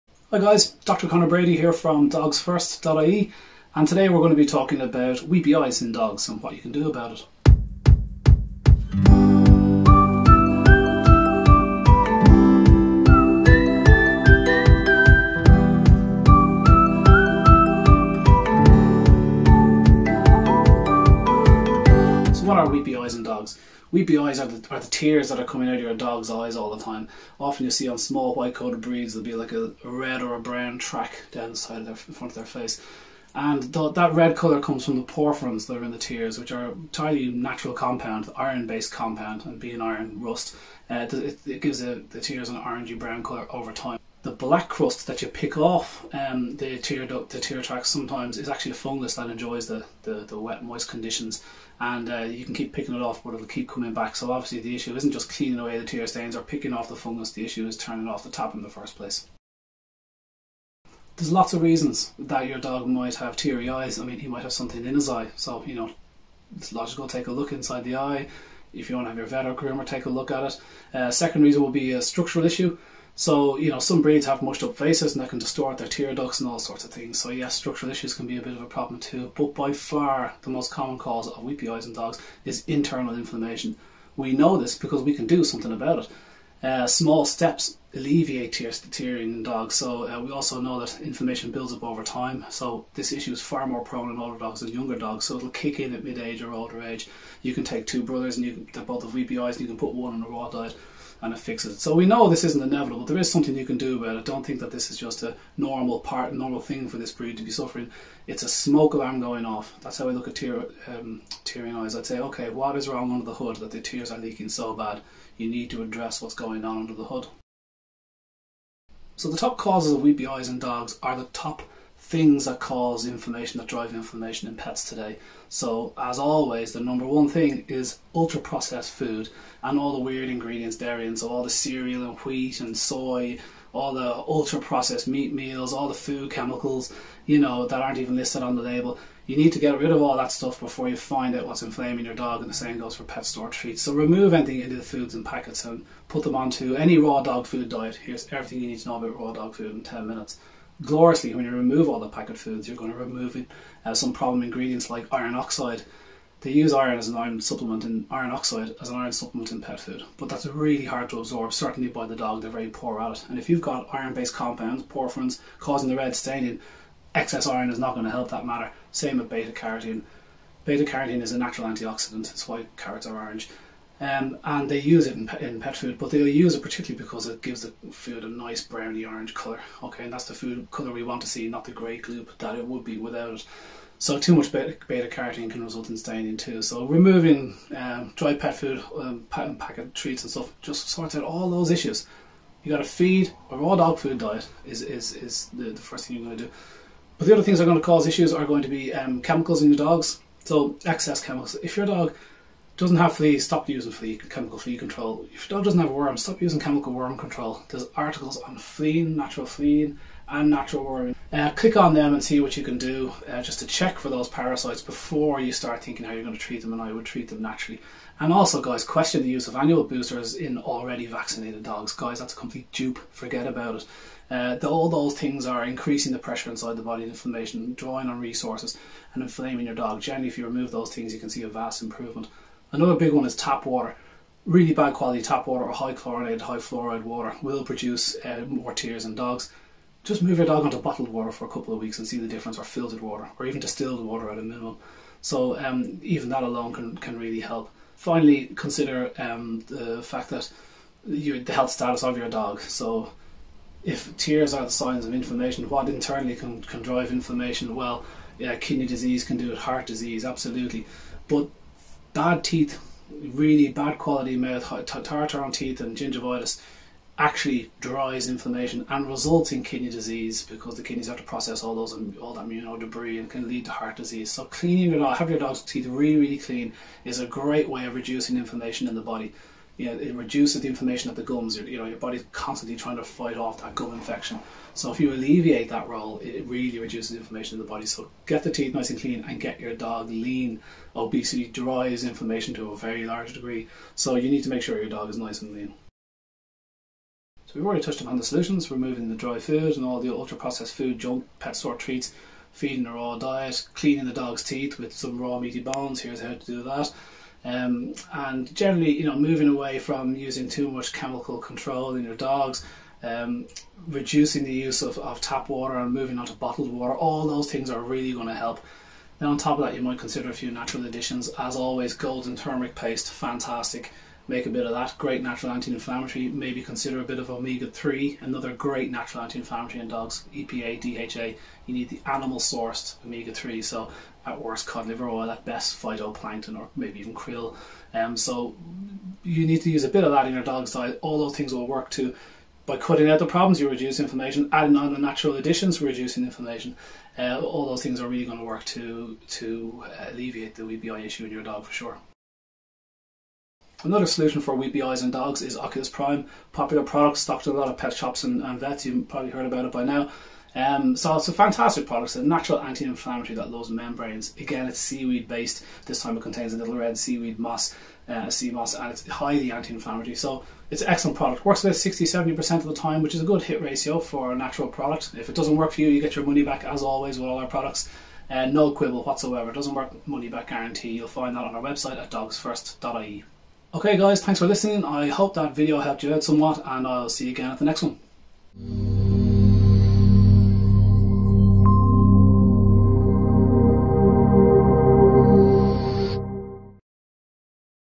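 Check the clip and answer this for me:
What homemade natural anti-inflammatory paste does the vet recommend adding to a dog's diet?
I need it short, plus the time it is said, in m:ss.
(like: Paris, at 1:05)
Golden turmeric paste, at 5:21.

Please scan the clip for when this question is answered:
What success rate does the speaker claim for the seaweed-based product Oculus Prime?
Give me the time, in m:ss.
6:11.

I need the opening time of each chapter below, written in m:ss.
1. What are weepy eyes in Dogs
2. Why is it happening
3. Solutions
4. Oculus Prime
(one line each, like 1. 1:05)
1. 0:22
2. 0:59
3. 4:55
4. 5:52.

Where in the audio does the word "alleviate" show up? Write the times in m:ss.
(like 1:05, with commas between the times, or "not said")
1:27, 4:45, 5:50.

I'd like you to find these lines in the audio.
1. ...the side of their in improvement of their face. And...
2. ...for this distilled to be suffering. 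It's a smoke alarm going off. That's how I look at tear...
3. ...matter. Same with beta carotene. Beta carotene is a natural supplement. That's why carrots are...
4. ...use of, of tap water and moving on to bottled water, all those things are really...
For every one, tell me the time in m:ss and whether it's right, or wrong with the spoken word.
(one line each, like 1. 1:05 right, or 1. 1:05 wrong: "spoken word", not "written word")
1. 0:31 wrong: "front", not "improvement"
2. 1:46 wrong: "breed", not "distilled"
3. 2:48 wrong: "antioxidant", not "supplement"
4. 5:14 right.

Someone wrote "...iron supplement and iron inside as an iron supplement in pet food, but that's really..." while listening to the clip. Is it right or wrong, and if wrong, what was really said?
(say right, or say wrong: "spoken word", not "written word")
wrong: "oxide", not "inside".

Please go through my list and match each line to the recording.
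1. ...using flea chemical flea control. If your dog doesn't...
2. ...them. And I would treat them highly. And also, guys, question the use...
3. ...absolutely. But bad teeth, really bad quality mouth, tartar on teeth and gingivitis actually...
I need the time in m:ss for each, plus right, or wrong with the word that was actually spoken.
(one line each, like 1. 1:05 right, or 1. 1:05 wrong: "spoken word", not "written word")
1. 3:23 right
2. 3:36 wrong: "naturally", not "highly"
3. 4:20 right.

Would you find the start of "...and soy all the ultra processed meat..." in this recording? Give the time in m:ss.
2:12.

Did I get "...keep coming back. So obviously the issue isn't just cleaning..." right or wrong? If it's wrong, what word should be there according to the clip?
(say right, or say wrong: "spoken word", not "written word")
right.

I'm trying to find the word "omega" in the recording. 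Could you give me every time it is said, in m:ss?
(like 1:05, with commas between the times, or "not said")
5:27, 5:33.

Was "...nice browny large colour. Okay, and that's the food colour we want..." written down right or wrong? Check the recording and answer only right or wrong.
wrong.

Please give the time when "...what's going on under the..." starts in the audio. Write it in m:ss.
1:56.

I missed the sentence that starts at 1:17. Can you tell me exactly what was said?
So, yes, structural issues can be a bit of a problem too.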